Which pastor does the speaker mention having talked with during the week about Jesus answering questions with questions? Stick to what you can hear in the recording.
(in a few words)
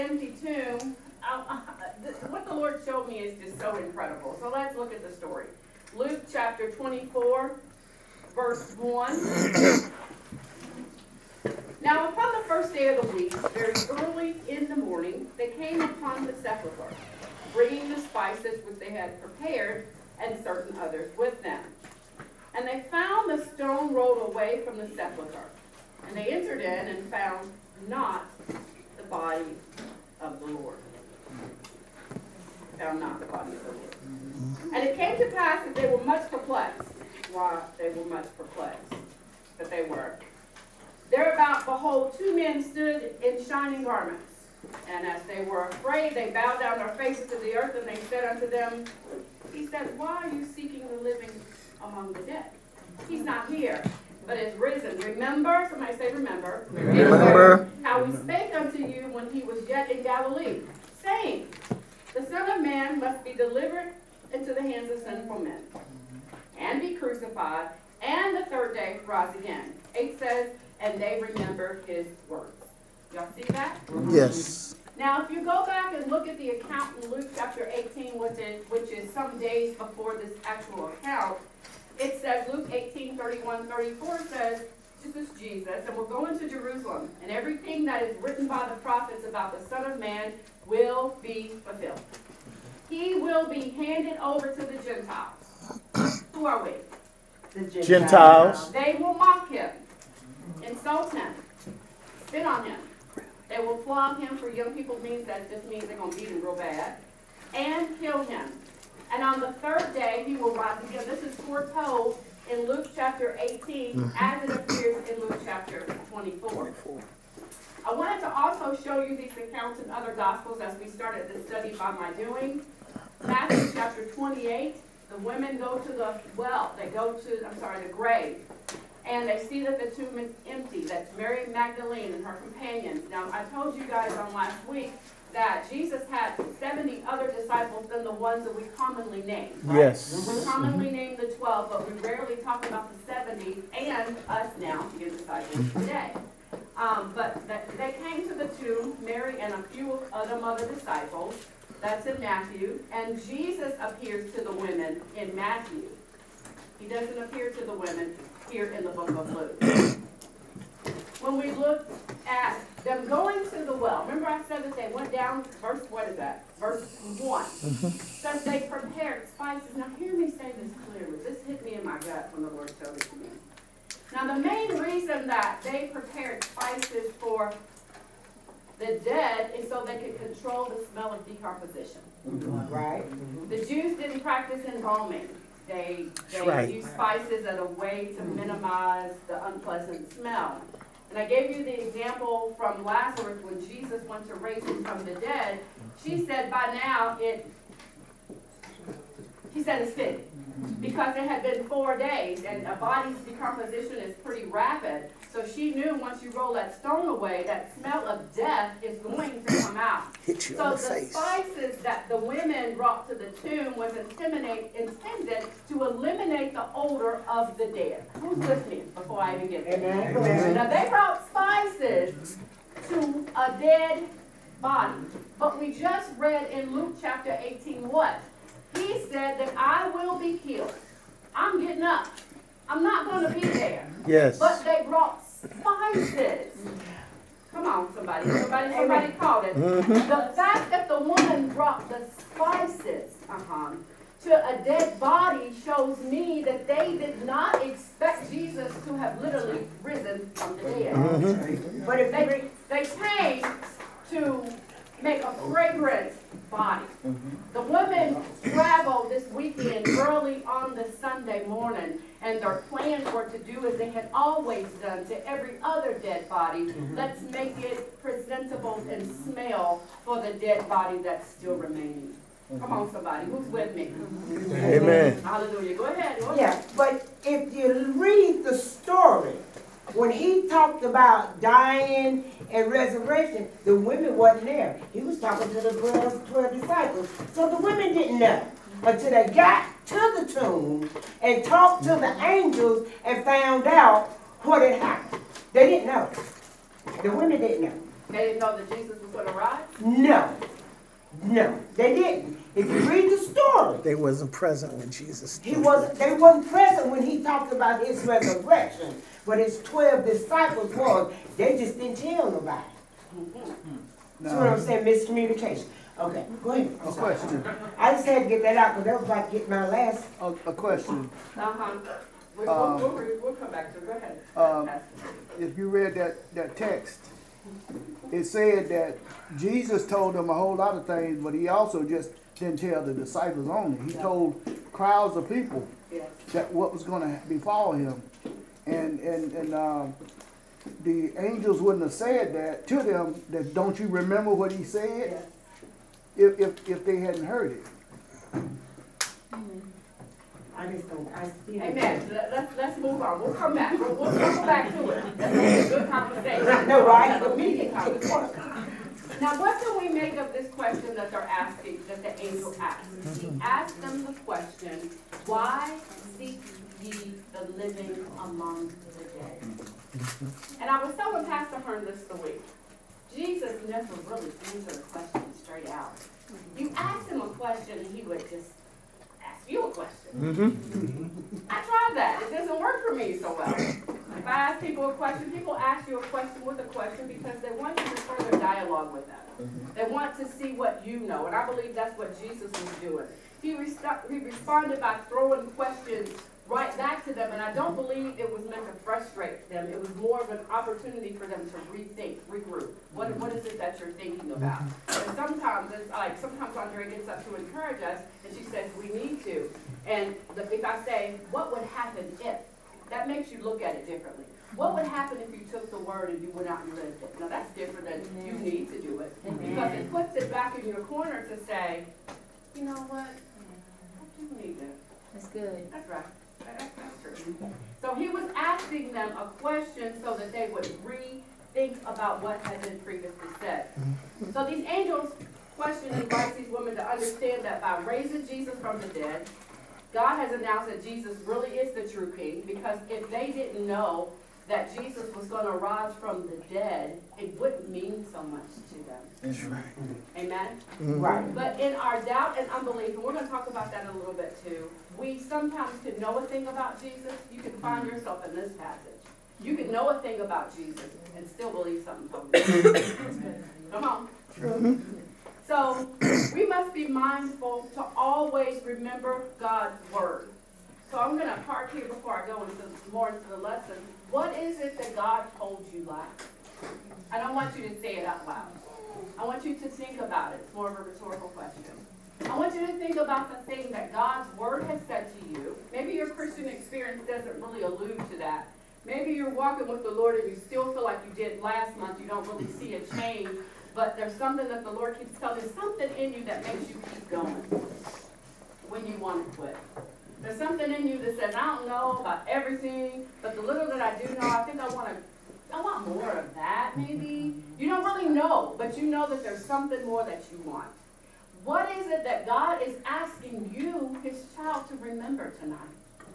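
Pastor Hearn.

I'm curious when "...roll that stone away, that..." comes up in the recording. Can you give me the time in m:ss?
3:26.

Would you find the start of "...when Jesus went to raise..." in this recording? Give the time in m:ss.
3:13.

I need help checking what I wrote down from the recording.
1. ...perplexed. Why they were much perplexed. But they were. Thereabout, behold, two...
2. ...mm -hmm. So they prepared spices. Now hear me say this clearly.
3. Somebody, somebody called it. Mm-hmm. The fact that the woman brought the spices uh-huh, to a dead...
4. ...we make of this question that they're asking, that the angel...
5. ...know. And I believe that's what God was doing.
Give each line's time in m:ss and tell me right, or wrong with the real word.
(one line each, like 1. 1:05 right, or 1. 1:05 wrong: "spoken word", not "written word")
1. 0:36 right
2. 2:47 right
3. 3:58 right
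4. 5:59 right
5. 6:30 wrong: "Jesus", not "God".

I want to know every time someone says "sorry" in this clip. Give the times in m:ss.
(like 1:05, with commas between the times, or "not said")
2:07, 5:16.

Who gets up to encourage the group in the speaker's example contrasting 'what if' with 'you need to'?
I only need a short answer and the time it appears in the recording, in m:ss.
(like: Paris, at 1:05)
Andrea, at 6:46.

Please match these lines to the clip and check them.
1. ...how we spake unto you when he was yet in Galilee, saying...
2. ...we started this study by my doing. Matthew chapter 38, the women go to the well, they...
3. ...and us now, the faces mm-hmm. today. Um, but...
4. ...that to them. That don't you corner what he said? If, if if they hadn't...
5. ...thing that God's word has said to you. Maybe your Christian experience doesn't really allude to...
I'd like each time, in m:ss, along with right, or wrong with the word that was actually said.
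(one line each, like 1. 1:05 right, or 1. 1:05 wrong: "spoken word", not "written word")
1. 0:57 right
2. 2:00 wrong: "28", not "38"
3. 2:23 wrong: "disciples", not "faces"
4. 5:42 wrong: "remember", not "corner"
5. 8:03 right.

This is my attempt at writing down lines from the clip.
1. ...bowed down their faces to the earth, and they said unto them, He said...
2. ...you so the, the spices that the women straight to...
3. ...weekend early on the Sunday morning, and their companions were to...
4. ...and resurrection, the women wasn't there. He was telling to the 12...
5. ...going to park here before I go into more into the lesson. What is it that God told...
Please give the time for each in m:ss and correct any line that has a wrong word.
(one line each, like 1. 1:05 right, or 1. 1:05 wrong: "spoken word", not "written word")
1. 0:46 right
2. 3:30 wrong: "brought", not "straight"
3. 4:19 wrong: "plans", not "companions"
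4. 4:42 wrong: "talking", not "telling"
5. 7:51 right.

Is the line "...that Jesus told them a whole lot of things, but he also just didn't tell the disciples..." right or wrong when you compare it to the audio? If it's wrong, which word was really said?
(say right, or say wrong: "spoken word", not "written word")
right.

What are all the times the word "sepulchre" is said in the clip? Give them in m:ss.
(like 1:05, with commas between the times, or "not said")
0:16, 0:24.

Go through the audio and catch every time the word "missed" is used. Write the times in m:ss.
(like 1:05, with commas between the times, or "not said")
not said.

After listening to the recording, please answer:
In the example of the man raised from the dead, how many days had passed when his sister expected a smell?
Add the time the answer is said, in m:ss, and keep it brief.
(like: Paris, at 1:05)
4, at 3:21.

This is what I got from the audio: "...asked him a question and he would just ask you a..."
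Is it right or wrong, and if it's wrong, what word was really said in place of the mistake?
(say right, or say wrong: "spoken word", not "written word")
right.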